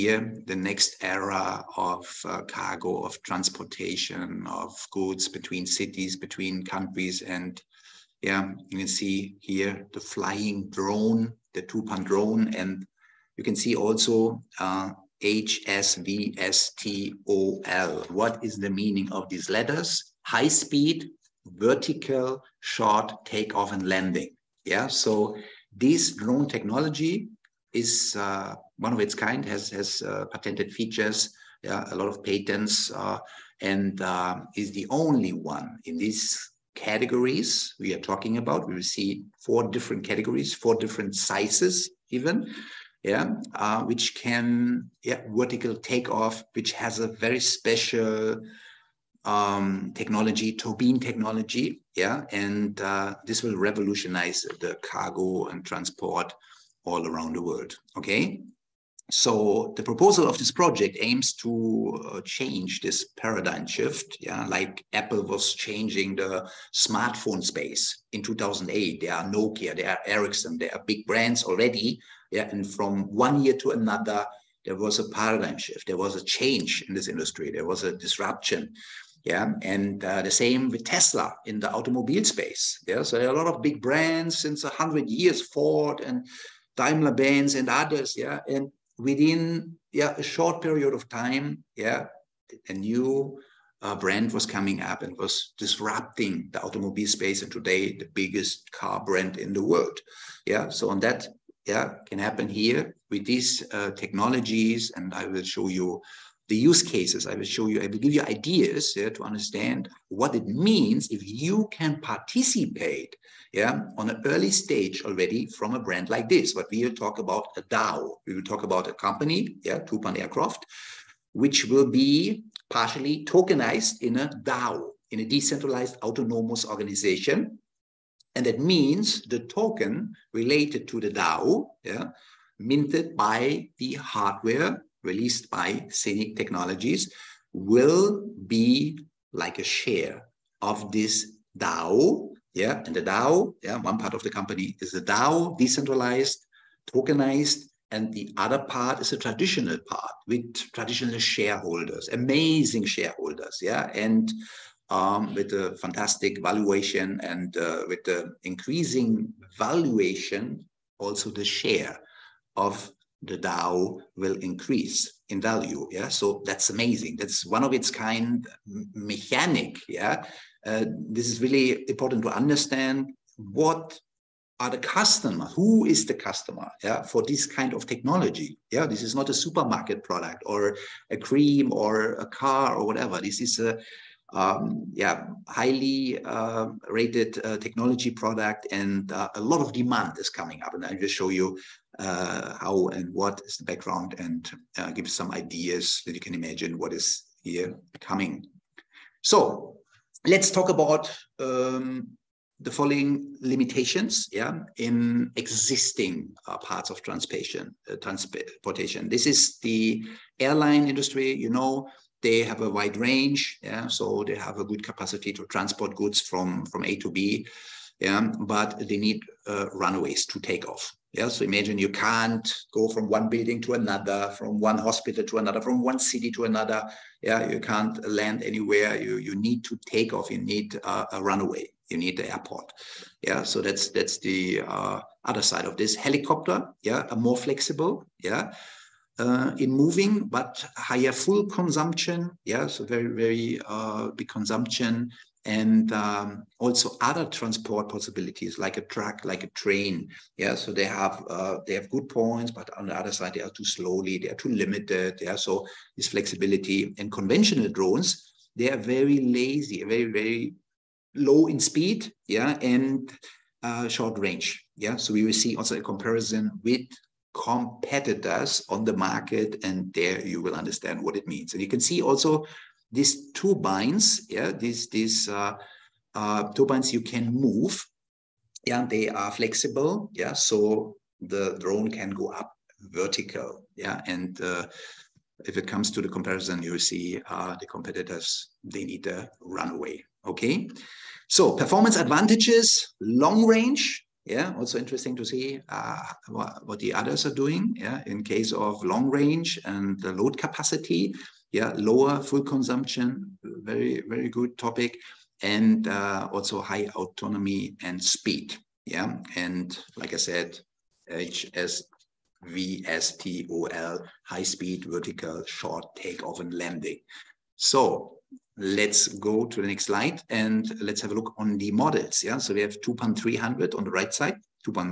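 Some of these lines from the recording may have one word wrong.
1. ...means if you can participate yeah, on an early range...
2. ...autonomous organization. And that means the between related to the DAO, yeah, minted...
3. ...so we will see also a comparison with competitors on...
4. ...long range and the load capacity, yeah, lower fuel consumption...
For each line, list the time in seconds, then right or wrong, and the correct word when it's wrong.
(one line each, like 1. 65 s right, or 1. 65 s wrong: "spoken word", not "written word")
1. 110 s wrong: "stage", not "range"
2. 126 s wrong: "token", not "between"
3. 264 s right
4. 298 s right.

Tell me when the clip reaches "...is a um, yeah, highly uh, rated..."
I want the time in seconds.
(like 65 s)
183 s.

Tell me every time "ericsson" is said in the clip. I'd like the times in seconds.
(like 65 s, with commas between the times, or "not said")
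70 s.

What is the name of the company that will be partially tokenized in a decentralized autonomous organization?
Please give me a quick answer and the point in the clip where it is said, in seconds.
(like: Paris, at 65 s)
Tupan Aircraft, at 119 s.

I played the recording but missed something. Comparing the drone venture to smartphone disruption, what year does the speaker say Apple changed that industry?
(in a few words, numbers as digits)
2008.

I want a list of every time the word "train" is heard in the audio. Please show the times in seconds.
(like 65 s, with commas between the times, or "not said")
249 s.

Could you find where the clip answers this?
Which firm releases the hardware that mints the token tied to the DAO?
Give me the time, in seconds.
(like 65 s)
135 s.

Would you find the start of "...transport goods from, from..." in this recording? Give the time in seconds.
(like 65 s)
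215 s.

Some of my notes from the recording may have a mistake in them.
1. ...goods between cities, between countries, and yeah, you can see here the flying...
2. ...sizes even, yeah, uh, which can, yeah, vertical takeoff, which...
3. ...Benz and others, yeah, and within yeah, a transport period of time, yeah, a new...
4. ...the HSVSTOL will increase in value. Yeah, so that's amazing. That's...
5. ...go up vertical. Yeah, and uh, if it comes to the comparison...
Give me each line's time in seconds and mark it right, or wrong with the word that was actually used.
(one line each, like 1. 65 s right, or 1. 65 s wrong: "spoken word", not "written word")
1. 4 s right
2. 41 s right
3. 87 s wrong: "short", not "transport"
4. 163 s wrong: "DAO", not "HSVSTOL"
5. 282 s right.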